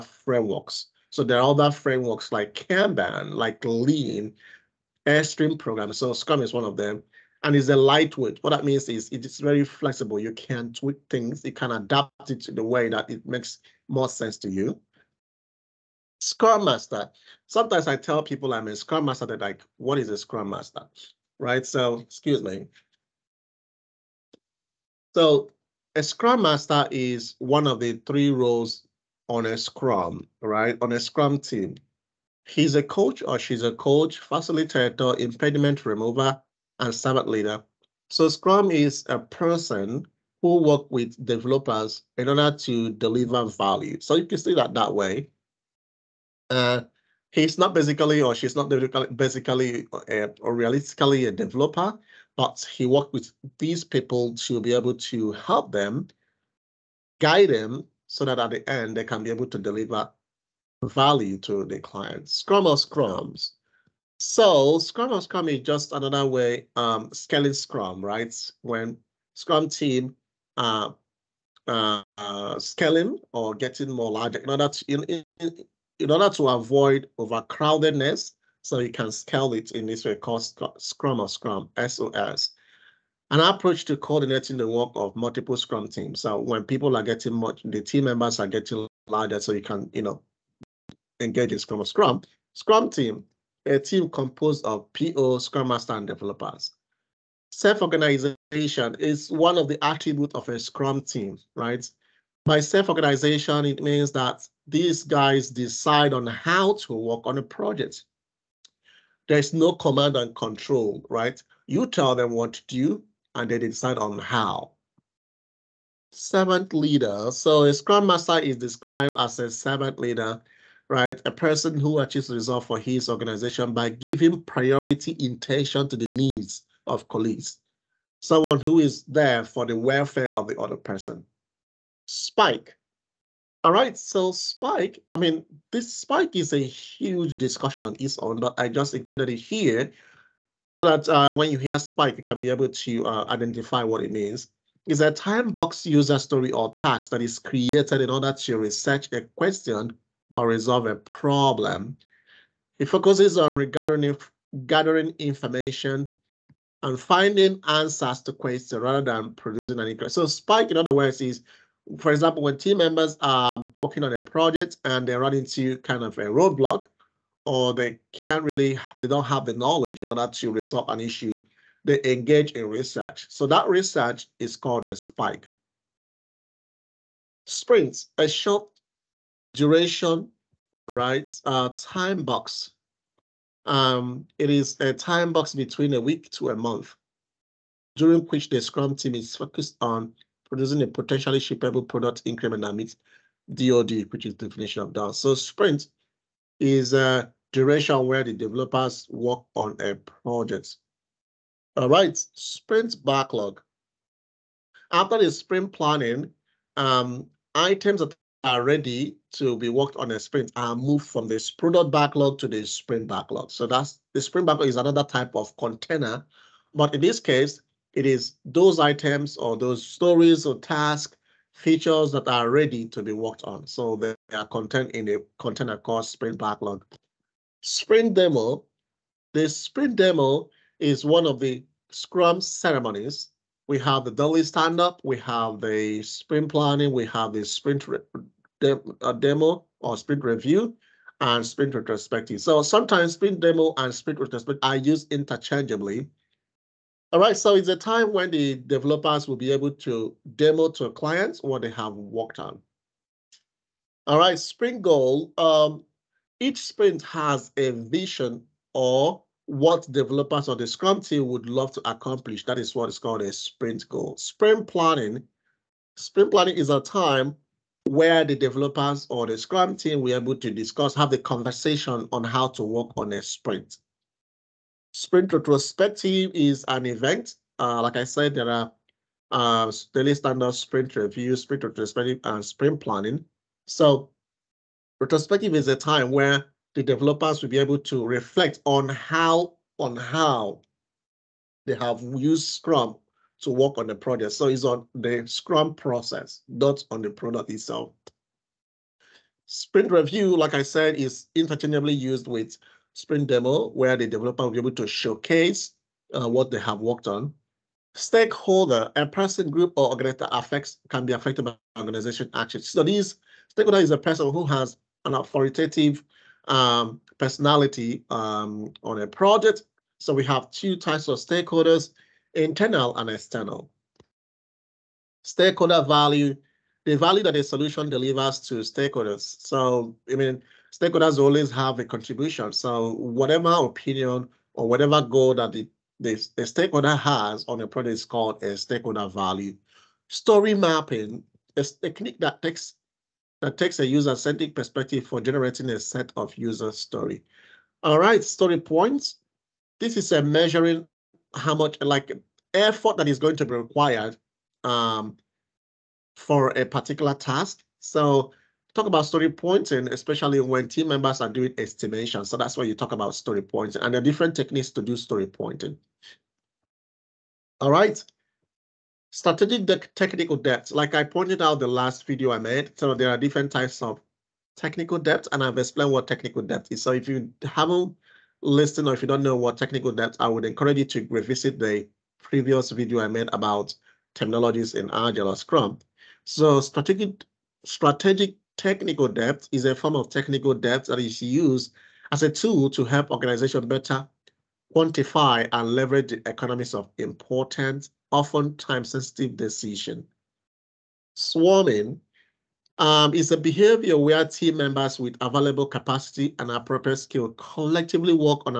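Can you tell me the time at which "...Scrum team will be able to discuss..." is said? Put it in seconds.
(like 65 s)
269 s.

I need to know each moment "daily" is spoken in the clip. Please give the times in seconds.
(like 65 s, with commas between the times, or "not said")
234 s, 279 s.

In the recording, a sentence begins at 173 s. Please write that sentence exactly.
So that research is called a spike.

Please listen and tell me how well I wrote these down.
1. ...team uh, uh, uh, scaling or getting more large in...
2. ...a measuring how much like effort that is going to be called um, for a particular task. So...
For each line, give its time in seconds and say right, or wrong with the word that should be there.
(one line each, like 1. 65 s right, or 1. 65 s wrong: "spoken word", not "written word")
1. 69 s right
2. 350 s wrong: "required", not "called".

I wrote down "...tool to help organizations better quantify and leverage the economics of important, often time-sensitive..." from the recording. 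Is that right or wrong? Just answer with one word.
right.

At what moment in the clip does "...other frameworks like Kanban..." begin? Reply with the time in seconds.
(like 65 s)
1 s.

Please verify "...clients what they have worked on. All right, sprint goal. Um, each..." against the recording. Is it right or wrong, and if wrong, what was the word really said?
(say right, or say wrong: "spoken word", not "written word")
right.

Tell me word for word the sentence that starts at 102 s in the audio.
By self-organization, it means that these guys decide on how to work on a project.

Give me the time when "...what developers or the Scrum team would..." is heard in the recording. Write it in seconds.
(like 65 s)
259 s.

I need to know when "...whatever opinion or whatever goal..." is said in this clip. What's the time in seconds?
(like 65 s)
332 s.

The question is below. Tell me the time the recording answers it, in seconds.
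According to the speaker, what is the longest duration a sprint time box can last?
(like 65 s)
186 s.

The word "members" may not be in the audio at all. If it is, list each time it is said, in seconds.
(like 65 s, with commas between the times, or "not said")
88 s, 162 s, 360 s, 404 s.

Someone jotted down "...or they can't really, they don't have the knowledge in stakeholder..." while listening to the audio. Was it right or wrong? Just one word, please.
wrong.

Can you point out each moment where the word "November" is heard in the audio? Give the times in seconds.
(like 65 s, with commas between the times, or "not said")
not said.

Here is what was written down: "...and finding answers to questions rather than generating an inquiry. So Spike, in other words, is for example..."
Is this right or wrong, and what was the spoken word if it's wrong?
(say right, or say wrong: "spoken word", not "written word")
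wrong: "producing", not "generating".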